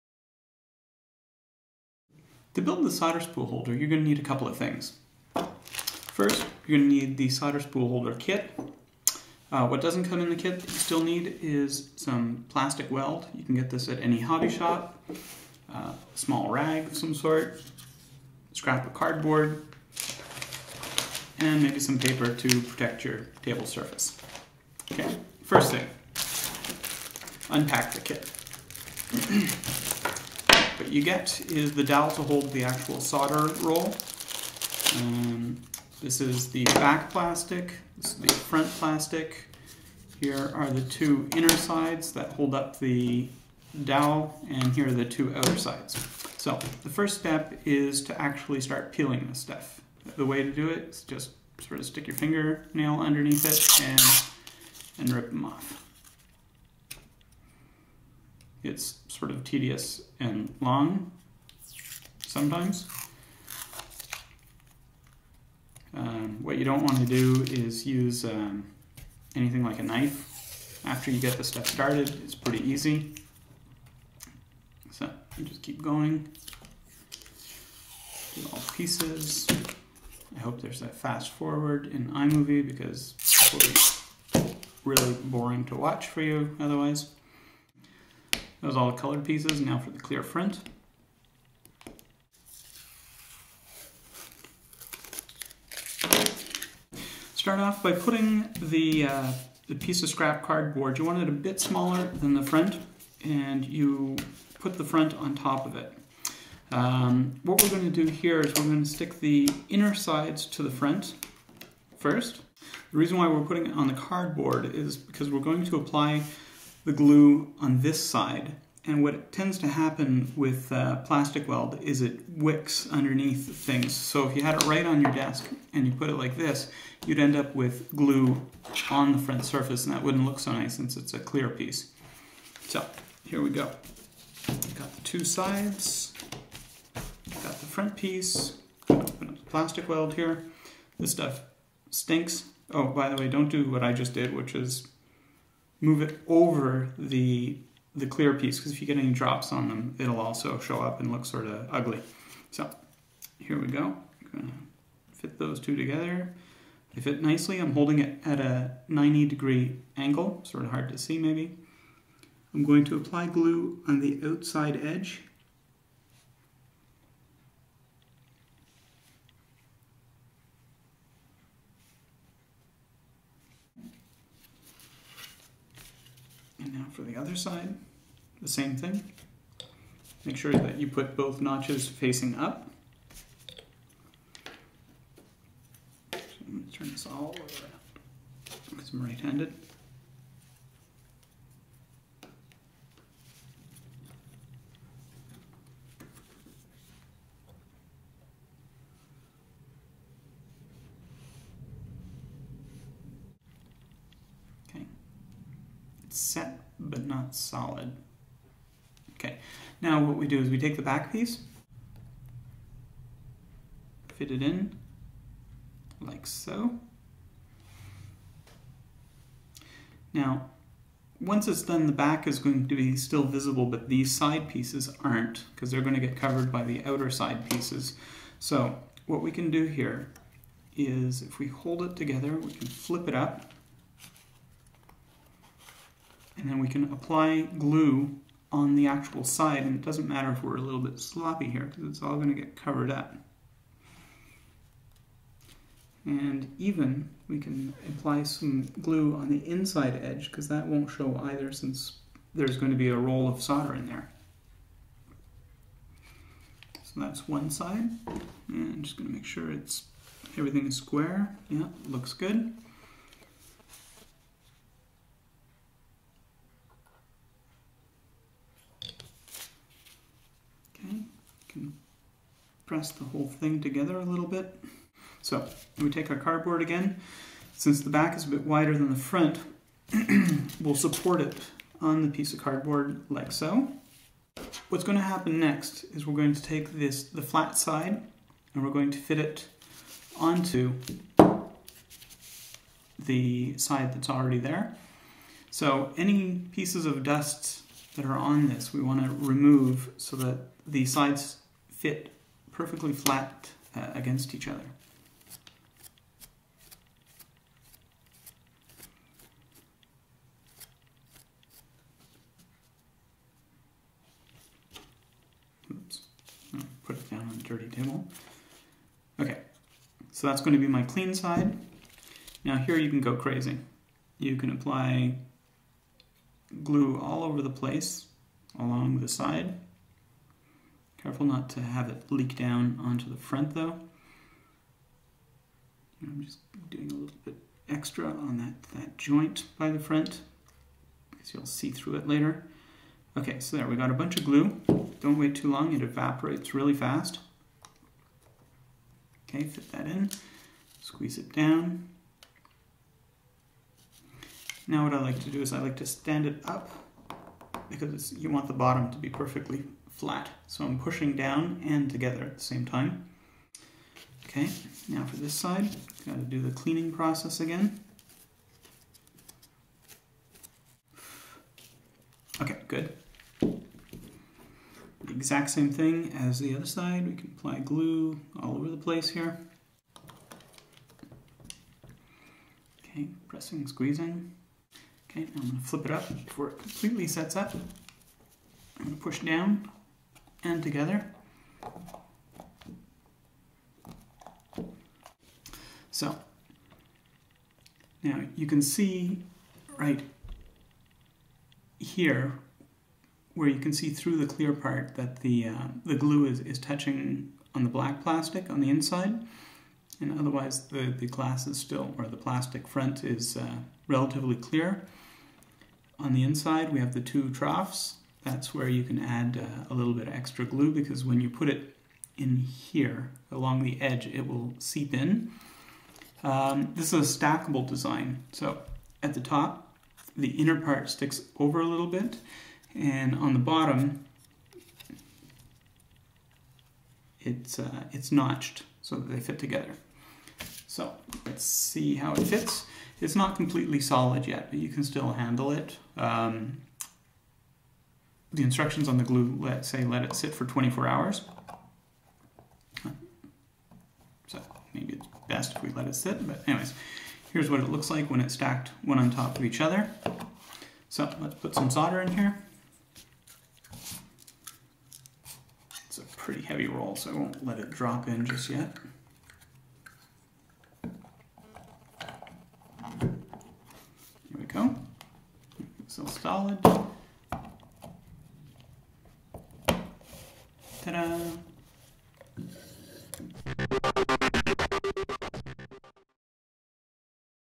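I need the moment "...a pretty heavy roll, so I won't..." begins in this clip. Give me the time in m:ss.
7:45.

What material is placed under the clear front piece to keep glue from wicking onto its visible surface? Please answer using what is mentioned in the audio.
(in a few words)
scrap cardboard.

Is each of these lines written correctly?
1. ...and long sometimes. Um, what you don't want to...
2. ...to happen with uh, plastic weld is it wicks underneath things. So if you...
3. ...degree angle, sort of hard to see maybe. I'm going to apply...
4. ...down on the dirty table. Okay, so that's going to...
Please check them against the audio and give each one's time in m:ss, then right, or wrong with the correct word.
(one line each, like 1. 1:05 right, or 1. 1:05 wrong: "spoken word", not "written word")
1. 1:00 right
2. 1:59 right
3. 2:39 right
4. 5:17 right.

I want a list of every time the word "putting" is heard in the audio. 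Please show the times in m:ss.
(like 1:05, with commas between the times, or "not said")
1:37, 1:53.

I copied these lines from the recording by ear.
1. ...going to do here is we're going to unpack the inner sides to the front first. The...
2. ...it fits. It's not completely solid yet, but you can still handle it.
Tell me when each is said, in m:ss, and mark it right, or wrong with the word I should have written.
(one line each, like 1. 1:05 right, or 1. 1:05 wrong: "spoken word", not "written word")
1. 1:47 wrong: "stick", not "unpack"
2. 7:22 right.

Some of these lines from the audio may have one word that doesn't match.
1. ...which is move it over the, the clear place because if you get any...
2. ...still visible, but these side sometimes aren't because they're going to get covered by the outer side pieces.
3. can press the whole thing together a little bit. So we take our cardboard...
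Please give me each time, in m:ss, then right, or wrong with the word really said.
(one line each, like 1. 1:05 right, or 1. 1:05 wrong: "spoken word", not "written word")
1. 2:24 wrong: "piece", not "place"
2. 3:42 wrong: "pieces", not "sometimes"
3. 4:31 right.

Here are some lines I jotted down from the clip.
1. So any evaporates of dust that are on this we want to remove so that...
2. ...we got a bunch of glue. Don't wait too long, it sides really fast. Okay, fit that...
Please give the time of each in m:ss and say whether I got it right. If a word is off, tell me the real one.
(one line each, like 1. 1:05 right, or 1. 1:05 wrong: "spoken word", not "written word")
1. 4:55 wrong: "pieces", not "evaporates"
2. 5:43 wrong: "evaporates", not "sides".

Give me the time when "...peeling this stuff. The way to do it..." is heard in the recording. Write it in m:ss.
0:48.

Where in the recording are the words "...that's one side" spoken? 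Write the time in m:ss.
4:16.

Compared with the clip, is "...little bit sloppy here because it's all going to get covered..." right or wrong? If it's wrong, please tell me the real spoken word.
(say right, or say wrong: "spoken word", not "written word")
right.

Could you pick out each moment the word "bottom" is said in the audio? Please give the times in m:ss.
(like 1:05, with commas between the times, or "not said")
5:58, 7:13.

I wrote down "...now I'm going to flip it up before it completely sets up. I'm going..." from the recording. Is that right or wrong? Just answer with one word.
right.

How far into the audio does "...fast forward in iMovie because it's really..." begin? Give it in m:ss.
1:20.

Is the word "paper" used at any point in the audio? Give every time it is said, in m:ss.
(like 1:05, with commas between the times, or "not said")
0:21.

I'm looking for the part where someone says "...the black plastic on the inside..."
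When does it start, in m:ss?
6:47.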